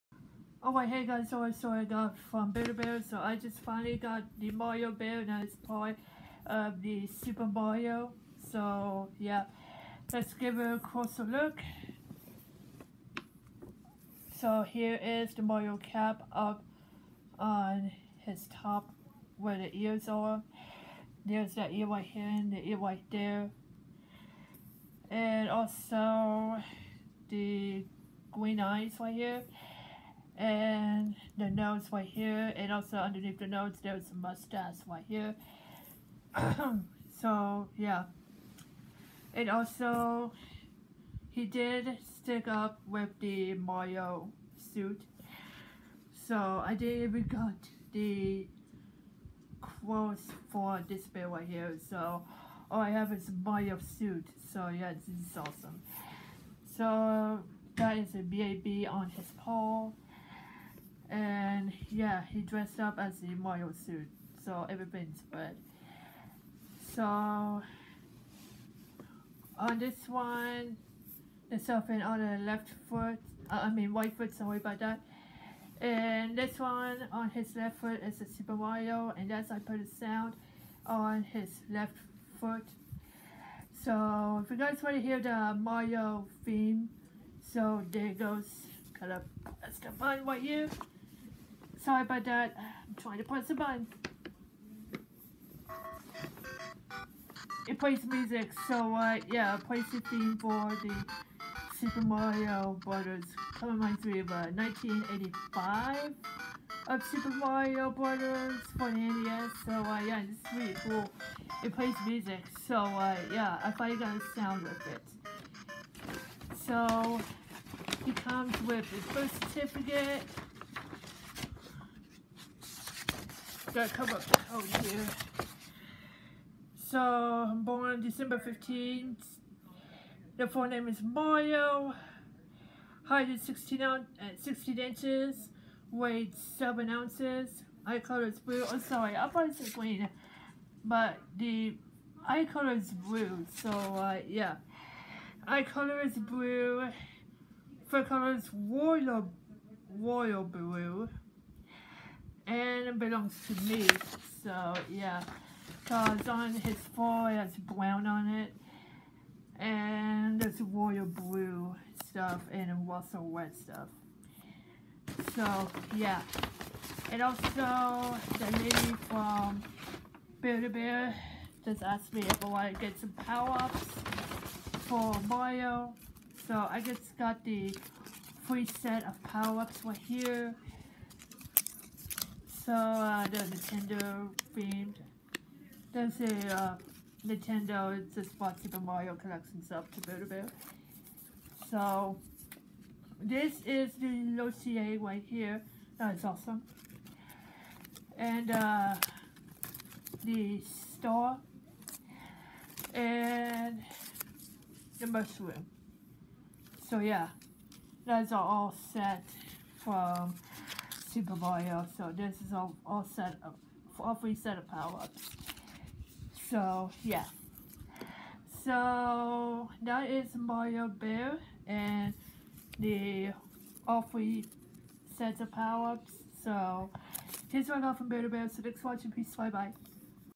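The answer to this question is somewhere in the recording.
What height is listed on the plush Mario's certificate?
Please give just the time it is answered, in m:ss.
2:14.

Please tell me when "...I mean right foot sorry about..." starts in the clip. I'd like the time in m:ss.
1:13.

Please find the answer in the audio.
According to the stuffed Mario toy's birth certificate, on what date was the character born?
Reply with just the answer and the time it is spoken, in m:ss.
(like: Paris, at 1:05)
December 15th, at 2:08.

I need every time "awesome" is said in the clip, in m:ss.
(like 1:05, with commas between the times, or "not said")
0:55, 3:16.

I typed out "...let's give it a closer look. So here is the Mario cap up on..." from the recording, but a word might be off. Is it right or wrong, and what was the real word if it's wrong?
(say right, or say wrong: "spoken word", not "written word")
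right.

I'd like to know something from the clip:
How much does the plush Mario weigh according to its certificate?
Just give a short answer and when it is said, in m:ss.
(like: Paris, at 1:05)
7 ounces, at 2:16.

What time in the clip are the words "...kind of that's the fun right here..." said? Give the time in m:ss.
1:28.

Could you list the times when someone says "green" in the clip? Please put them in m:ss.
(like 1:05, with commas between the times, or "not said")
0:28, 2:19.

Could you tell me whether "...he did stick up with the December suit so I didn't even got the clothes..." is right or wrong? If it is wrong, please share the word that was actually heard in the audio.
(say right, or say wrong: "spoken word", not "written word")
wrong: "Mario", not "December".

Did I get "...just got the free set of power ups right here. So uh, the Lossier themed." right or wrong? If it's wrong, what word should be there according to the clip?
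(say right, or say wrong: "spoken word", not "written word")
wrong: "Nintendo", not "Lossier".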